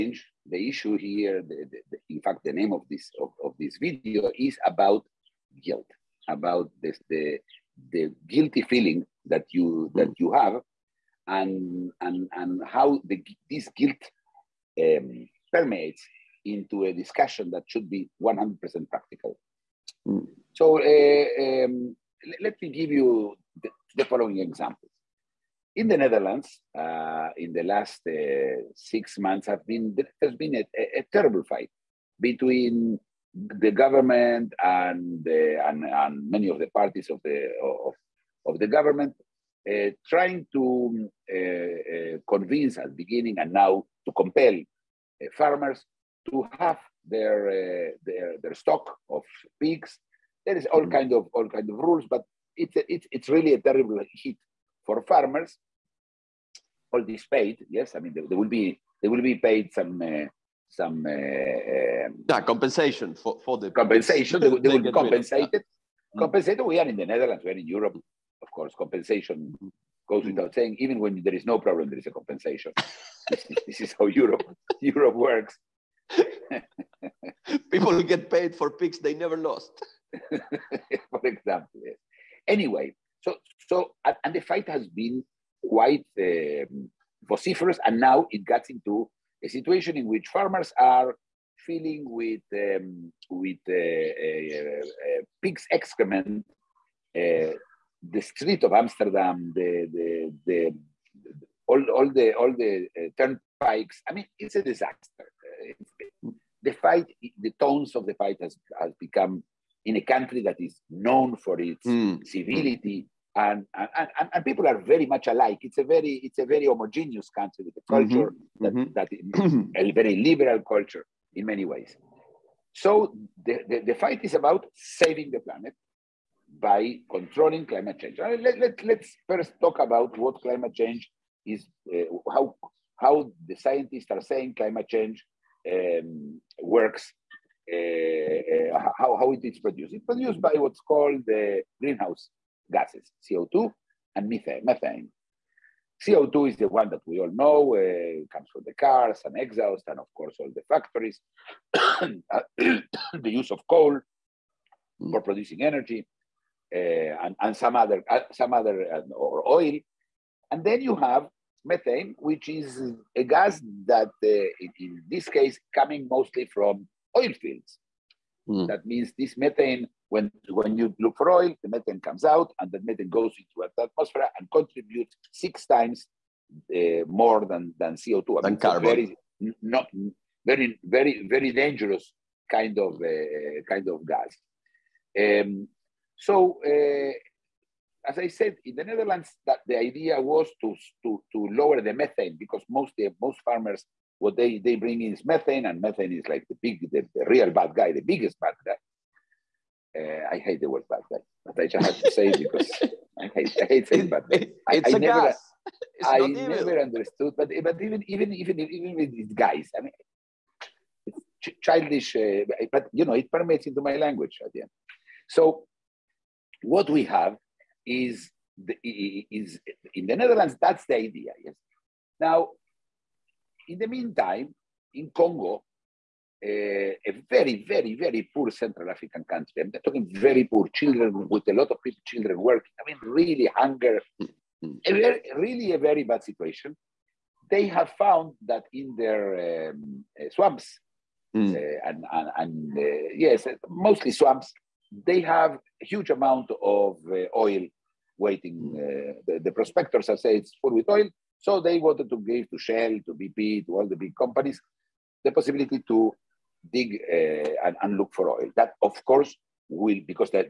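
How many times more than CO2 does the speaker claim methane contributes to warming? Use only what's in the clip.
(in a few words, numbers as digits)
6.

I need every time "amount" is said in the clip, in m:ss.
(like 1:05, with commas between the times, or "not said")
4:06.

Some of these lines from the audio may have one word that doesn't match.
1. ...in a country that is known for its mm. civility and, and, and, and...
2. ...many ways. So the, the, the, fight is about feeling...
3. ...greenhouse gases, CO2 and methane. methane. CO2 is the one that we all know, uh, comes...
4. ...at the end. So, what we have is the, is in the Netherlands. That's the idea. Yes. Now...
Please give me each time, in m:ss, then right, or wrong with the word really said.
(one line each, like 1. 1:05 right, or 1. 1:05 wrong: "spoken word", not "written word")
1. 1:49 right
2. 2:01 wrong: "saving", not "feeling"
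3. 2:21 right
4. 3:34 right.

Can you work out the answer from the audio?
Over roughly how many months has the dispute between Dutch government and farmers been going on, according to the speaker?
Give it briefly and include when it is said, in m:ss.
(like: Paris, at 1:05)
6, at 0:28.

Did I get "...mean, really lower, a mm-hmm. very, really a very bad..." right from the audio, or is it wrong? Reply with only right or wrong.
wrong.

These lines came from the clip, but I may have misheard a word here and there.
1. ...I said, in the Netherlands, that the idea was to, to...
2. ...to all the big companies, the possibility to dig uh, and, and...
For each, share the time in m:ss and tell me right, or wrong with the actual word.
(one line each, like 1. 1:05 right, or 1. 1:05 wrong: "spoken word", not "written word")
1. 3:08 right
2. 4:13 right.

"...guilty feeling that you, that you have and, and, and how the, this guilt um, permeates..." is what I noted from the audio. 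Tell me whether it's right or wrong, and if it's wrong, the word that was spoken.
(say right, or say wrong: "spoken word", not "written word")
right.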